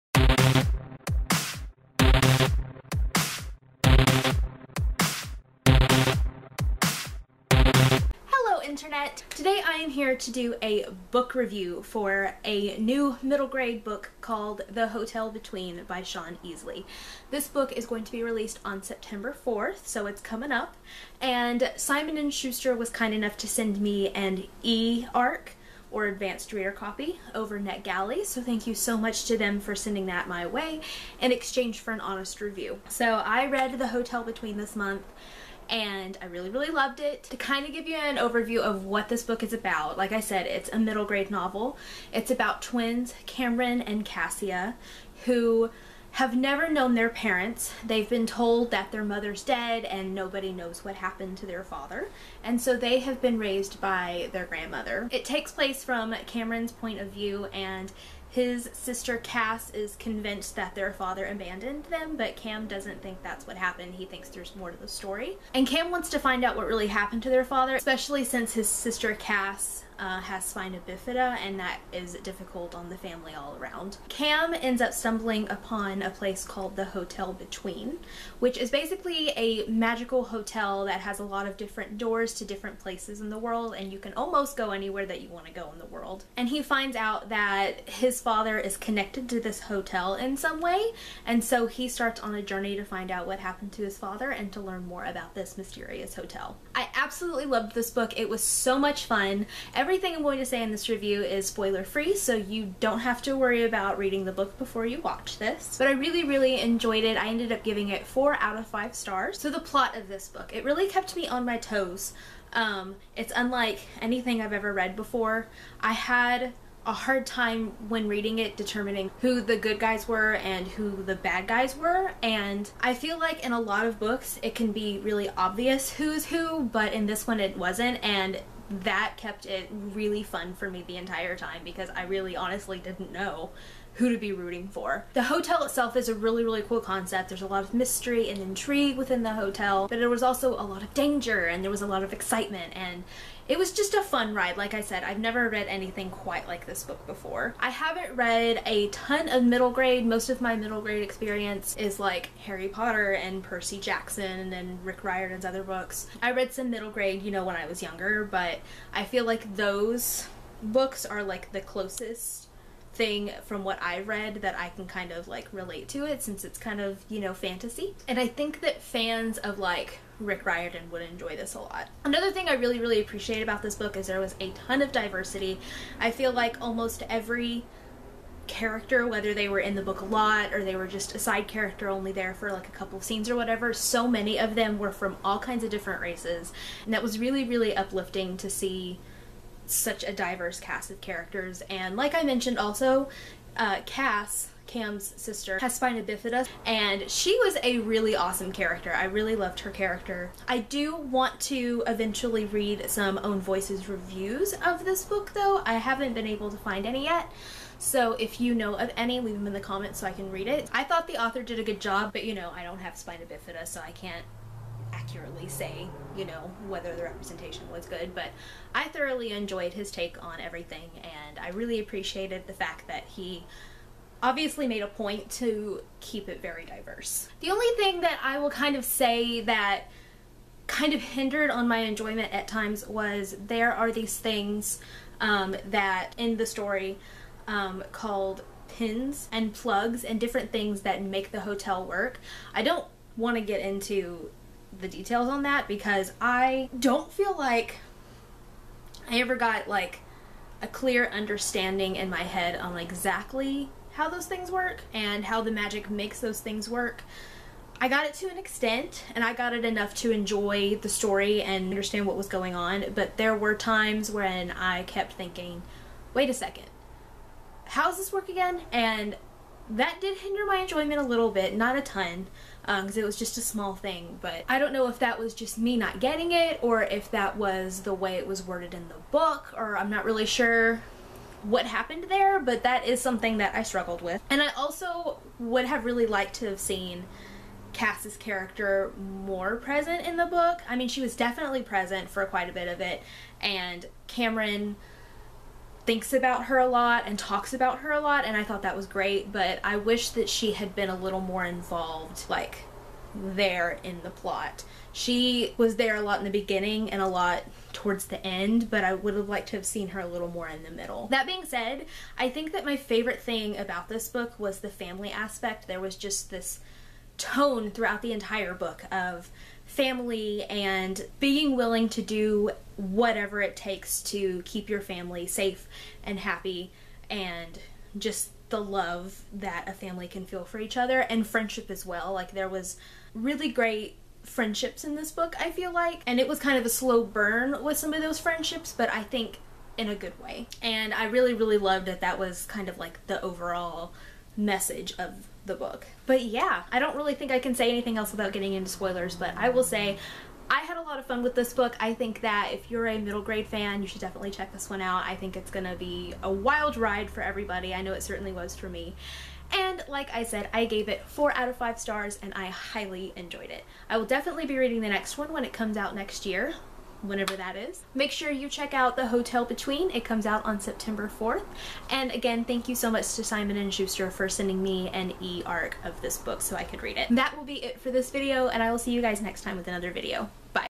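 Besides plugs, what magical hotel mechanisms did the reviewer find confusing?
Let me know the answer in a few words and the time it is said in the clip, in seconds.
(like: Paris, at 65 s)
pins, at 238 s.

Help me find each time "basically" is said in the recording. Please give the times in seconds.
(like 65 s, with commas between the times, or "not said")
78 s.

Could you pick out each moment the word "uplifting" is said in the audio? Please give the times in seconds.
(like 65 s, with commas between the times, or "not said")
187 s.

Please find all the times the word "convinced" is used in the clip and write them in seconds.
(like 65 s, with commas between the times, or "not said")
59 s.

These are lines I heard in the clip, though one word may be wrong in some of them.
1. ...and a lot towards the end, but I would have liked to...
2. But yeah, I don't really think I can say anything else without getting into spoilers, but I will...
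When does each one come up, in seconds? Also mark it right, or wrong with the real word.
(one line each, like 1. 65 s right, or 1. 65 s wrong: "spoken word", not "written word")
1. 306 s right
2. 346 s right.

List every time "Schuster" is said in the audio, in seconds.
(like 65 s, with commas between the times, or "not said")
22 s, 373 s.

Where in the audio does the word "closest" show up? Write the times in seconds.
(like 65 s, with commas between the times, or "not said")
161 s.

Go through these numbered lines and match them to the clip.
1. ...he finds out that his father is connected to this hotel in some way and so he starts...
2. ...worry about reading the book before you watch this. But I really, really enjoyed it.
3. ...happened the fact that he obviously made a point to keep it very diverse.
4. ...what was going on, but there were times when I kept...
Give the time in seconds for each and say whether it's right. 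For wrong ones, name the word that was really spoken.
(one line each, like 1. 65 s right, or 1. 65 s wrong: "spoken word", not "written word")
1. 86 s right
2. 103 s right
3. 221 s wrong: "appreciated", not "happened"
4. 262 s right.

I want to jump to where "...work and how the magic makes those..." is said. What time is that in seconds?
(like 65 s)
254 s.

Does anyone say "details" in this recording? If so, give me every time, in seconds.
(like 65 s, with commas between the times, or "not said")
244 s.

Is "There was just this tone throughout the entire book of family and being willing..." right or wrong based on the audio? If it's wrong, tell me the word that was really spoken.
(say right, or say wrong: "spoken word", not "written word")
right.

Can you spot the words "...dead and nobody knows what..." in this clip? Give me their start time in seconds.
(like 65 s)
49 s.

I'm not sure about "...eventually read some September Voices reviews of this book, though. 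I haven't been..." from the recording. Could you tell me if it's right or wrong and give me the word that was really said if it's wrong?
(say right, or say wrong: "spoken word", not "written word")
wrong: "Own", not "September".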